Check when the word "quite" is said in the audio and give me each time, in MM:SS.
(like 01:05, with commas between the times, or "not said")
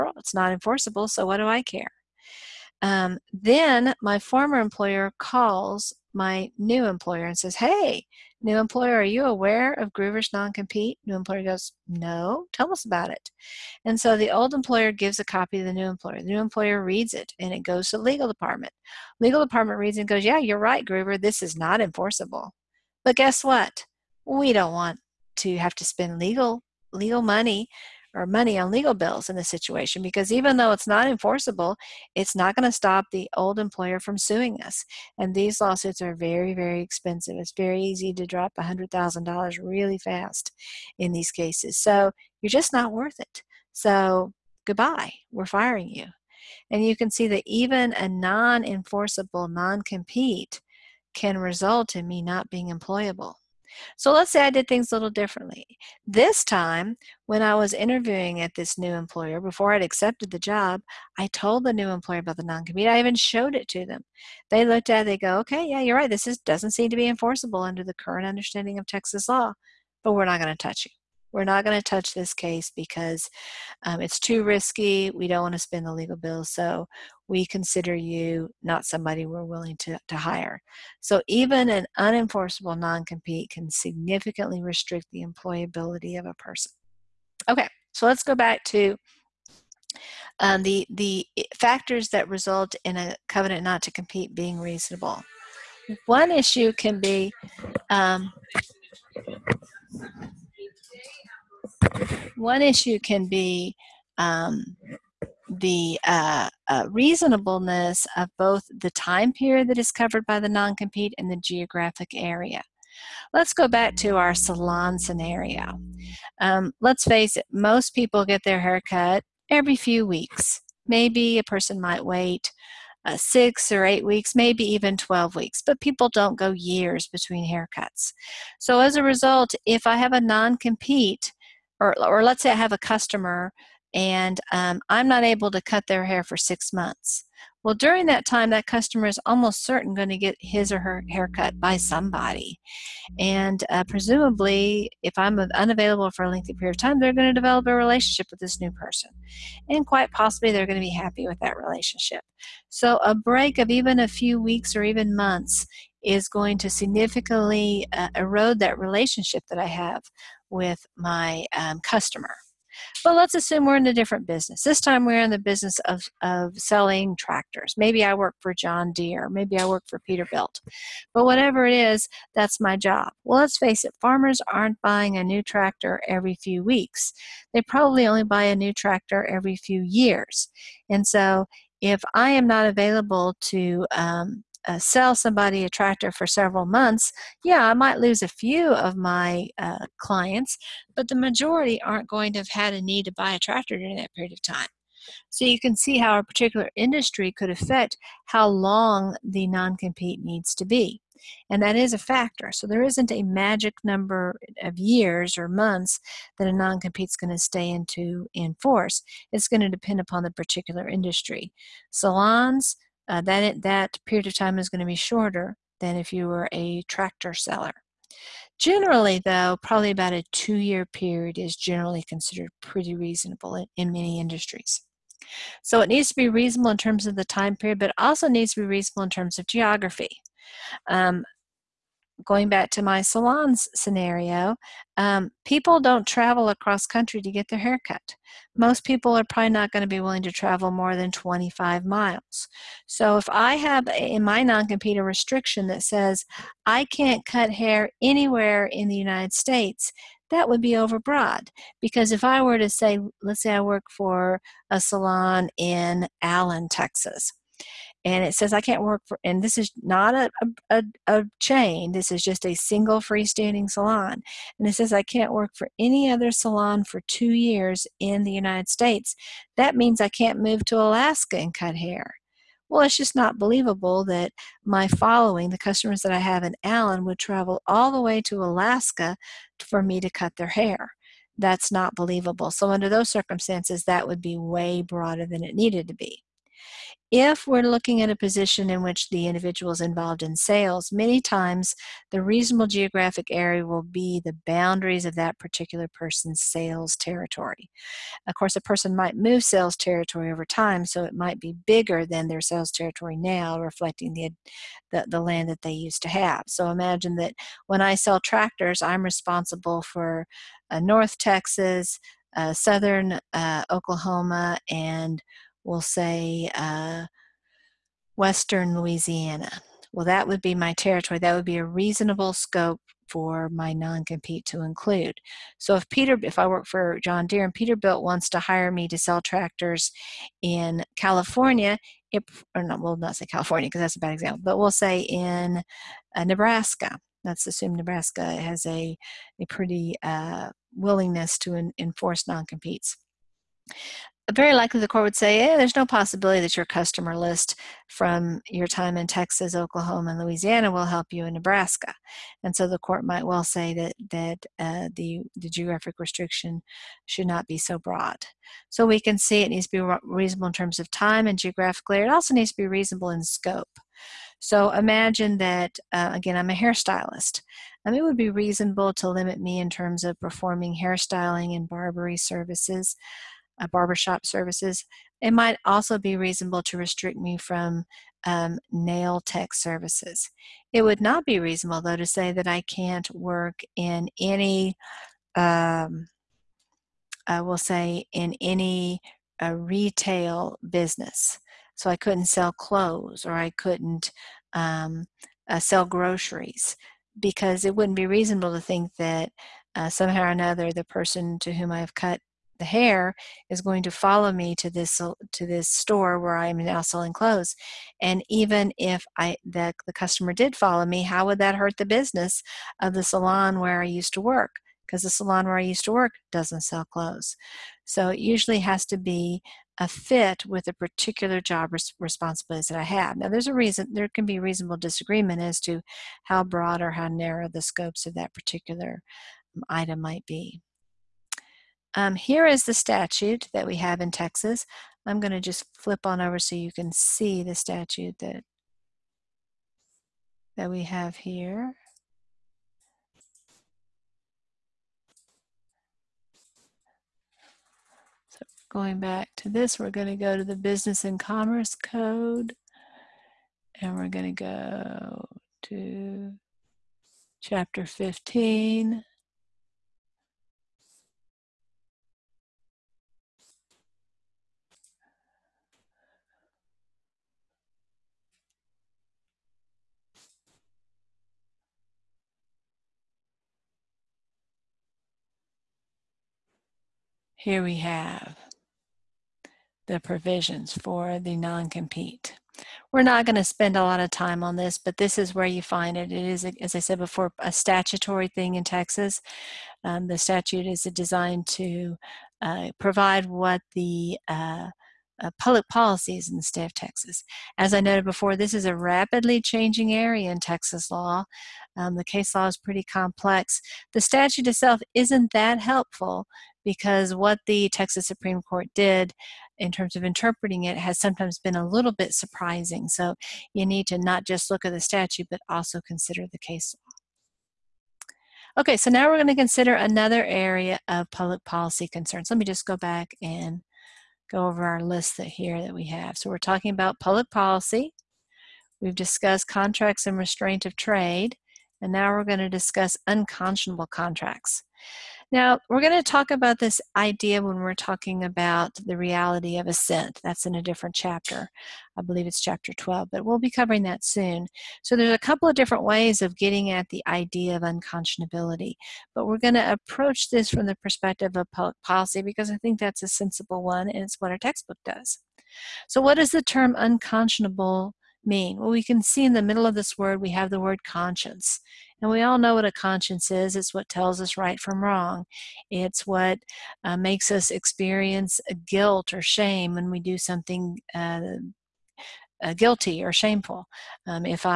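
02:29.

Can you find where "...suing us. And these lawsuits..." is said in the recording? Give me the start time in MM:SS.
00:34.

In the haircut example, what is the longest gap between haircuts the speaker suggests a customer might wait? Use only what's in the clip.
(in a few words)
12 weeks.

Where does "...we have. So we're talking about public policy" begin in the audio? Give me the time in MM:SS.
08:45.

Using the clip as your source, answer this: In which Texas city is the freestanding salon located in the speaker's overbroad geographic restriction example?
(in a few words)
Allen, Texas.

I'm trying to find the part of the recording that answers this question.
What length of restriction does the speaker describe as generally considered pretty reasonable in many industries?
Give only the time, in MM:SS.
03:40.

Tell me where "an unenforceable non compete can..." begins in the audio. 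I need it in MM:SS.
01:21.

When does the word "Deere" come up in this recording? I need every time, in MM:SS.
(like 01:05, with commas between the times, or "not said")
02:48, 05:27.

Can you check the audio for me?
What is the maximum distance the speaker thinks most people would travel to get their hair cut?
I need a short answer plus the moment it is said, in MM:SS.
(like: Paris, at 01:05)
25 miles, at 04:01.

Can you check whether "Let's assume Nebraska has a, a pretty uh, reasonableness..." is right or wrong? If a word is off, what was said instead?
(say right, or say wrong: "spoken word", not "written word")
wrong: "willingness", not "reasonableness".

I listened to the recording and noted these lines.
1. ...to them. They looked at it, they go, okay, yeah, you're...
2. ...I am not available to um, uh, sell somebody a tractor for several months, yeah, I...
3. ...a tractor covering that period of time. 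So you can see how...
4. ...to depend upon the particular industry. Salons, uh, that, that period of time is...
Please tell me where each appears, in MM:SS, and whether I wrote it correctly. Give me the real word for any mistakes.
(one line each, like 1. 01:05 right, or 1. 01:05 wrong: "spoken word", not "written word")
1. 01:03 right
2. 03:02 right
3. 03:13 wrong: "during", not "covering"
4. 03:29 right.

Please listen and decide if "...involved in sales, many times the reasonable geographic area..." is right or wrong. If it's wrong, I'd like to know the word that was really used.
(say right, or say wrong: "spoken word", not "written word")
right.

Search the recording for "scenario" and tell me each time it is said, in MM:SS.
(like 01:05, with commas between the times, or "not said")
01:54, 03:53.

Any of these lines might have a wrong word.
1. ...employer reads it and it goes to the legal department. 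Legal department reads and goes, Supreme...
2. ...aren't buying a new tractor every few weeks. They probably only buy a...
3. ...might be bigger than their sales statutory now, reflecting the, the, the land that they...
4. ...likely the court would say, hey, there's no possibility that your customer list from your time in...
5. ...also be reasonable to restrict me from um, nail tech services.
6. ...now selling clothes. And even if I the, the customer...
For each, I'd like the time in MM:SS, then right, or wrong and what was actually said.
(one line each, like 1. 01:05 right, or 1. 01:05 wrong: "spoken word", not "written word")
1. 00:16 wrong: "Yeah", not "Supreme"
2. 02:54 right
3. 05:01 wrong: "territory", not "statutory"
4. 05:44 right
5. 06:15 right
6. 06:46 right.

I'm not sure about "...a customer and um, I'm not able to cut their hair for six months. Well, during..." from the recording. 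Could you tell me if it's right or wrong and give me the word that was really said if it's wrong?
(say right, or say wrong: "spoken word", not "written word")
right.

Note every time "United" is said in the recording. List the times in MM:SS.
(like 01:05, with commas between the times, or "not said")
04:08, 04:28.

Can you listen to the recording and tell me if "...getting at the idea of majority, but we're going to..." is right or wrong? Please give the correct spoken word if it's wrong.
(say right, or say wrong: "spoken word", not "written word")
wrong: "unconscionability", not "majority".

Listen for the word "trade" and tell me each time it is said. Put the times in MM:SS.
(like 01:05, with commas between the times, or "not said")
08:50.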